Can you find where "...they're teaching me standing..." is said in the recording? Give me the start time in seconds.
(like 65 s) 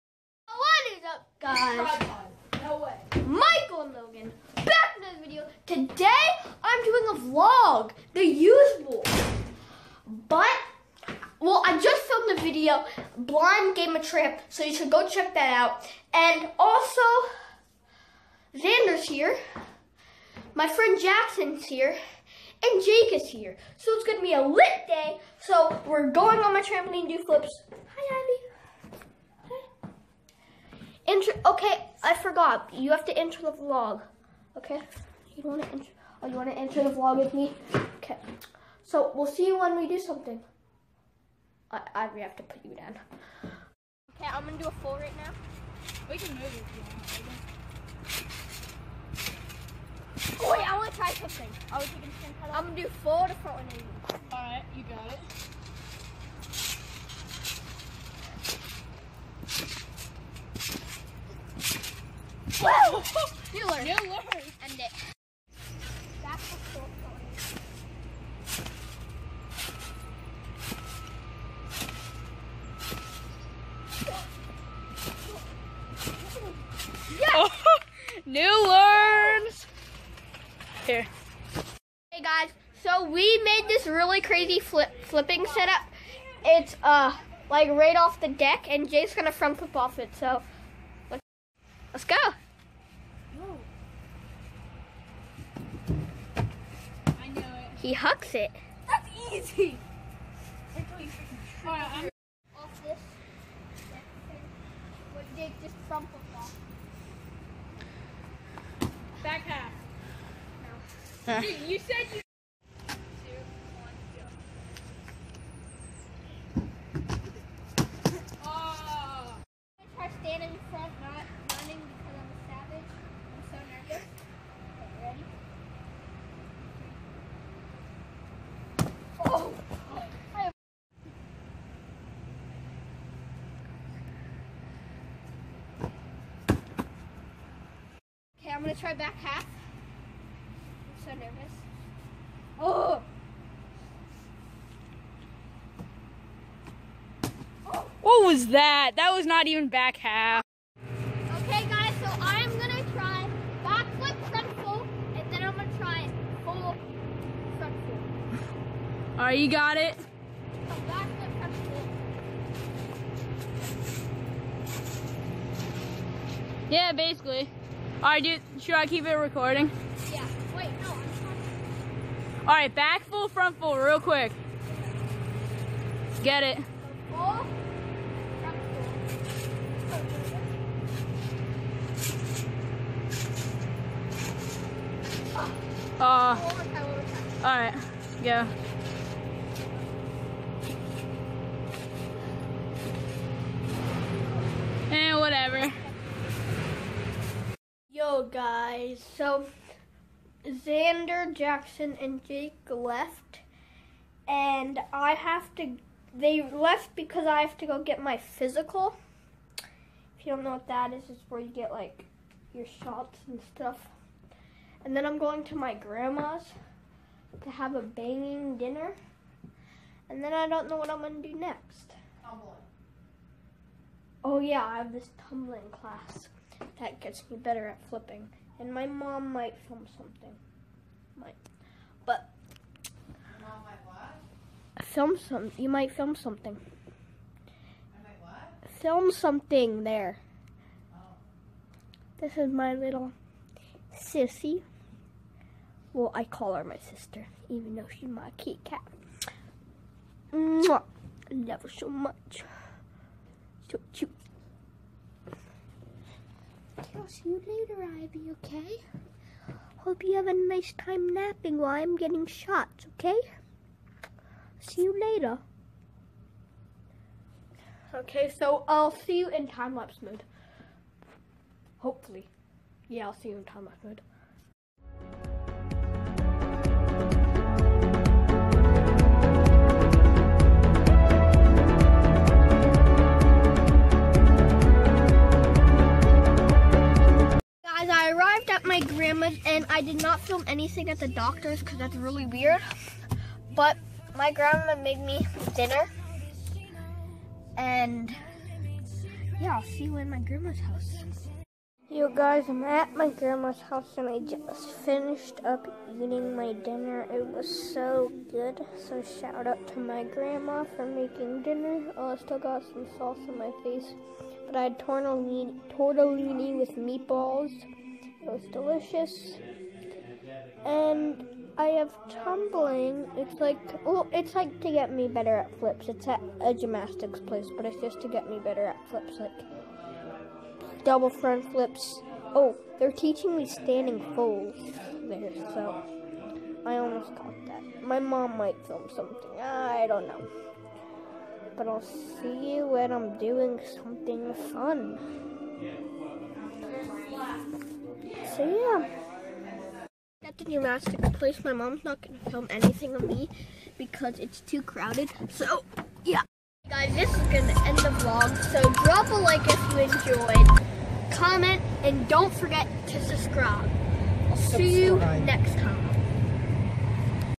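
332 s.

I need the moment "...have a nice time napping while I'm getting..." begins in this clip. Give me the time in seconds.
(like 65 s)
260 s.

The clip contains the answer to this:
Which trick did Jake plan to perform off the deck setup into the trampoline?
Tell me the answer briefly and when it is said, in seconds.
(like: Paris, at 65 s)
Front flip, at 89 s.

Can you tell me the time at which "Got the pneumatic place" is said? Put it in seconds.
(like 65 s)
350 s.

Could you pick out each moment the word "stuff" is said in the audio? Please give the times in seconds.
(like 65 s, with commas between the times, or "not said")
213 s.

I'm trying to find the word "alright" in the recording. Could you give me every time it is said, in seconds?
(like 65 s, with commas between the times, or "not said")
54 s, 159 s, 168 s, 172 s, 187 s.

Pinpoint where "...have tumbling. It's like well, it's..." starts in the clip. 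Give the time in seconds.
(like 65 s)
321 s.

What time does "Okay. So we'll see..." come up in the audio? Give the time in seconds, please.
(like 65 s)
37 s.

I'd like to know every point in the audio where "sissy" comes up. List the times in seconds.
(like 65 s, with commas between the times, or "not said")
243 s.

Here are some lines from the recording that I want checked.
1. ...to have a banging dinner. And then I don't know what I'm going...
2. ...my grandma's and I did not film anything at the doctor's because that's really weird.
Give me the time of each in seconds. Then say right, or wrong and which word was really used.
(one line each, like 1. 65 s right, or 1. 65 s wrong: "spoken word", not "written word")
1. 217 s right
2. 288 s right.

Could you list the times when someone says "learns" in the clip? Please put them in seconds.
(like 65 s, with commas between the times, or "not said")
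78 s.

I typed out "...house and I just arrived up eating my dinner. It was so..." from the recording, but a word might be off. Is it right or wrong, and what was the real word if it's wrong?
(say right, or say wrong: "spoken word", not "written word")
wrong: "finished", not "arrived".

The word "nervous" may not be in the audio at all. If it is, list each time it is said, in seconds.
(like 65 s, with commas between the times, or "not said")
141 s.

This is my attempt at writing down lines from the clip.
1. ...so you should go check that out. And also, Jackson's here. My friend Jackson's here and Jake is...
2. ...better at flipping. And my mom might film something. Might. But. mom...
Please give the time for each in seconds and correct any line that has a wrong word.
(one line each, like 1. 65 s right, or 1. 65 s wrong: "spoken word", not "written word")
1. 14 s wrong: "Xander", not "Jackson"
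2. 227 s right.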